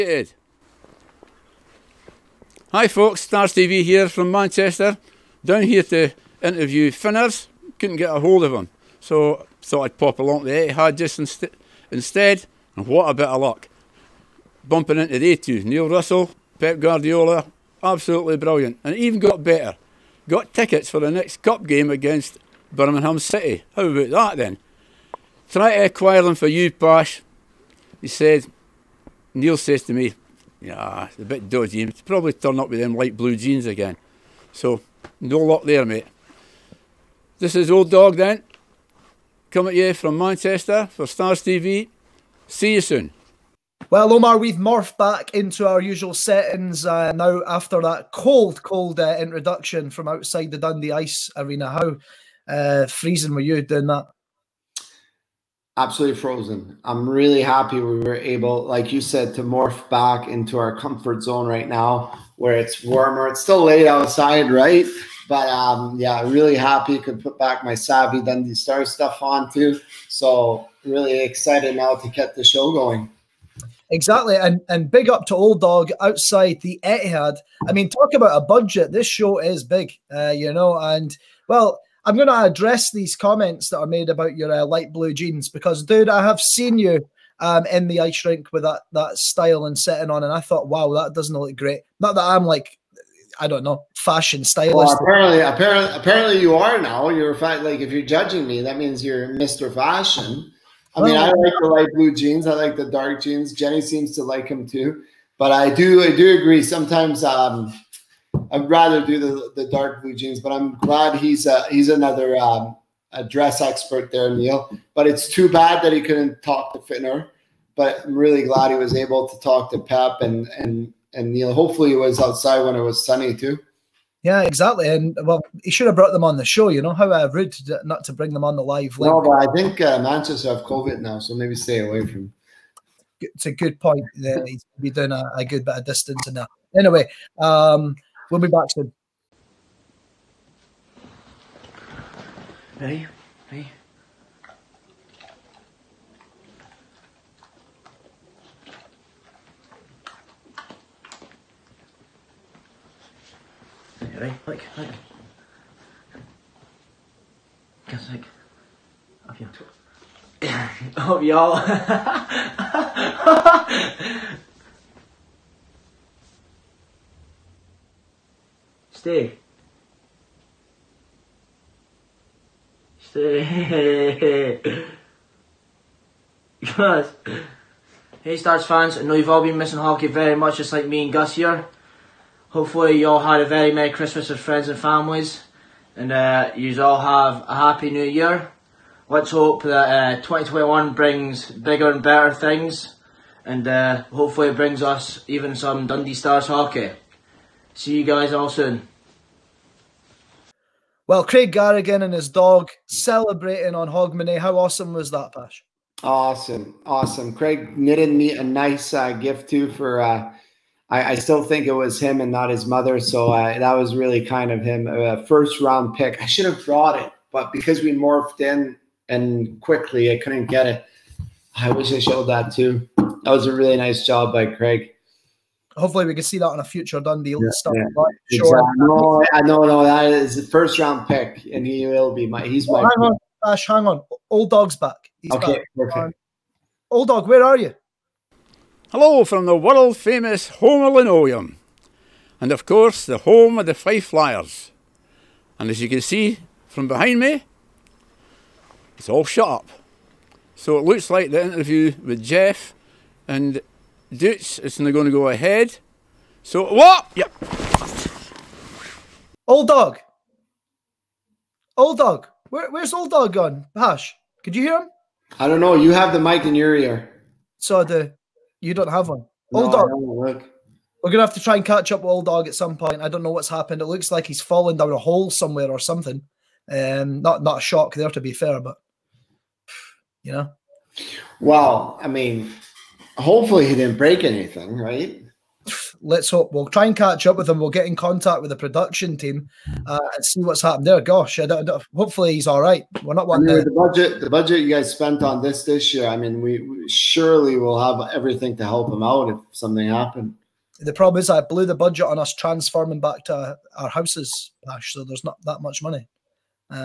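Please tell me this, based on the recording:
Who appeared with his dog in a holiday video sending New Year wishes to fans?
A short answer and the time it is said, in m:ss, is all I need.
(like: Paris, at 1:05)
Craig Garrigan, at 3:21.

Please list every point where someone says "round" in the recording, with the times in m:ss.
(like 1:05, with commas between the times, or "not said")
3:35, 3:50.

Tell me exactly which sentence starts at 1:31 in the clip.
Not that I'm like, I don't know, fashion stylist.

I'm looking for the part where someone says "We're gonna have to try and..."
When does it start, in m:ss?
4:31.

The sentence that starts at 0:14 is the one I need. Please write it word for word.
Bumping into the two, Neil Russell, Pep Guardiola, absolutely brilliant, and even got better.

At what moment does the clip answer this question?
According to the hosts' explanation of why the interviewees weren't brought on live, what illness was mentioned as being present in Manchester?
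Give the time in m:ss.
2:10.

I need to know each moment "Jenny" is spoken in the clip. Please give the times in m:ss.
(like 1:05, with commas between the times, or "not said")
1:43.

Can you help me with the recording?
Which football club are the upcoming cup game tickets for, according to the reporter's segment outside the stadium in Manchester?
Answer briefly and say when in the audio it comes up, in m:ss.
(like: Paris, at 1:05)
Birmingham City, at 0:22.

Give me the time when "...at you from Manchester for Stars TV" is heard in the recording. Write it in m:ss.
0:39.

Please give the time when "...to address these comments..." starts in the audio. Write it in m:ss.
1:22.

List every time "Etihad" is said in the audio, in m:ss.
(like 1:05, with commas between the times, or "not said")
0:10, 1:16.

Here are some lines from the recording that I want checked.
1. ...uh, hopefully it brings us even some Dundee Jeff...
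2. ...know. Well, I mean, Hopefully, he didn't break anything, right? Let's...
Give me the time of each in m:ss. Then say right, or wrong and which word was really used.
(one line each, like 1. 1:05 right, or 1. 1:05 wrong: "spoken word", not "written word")
1. 3:13 wrong: "Stars", not "Jeff"
2. 4:40 right.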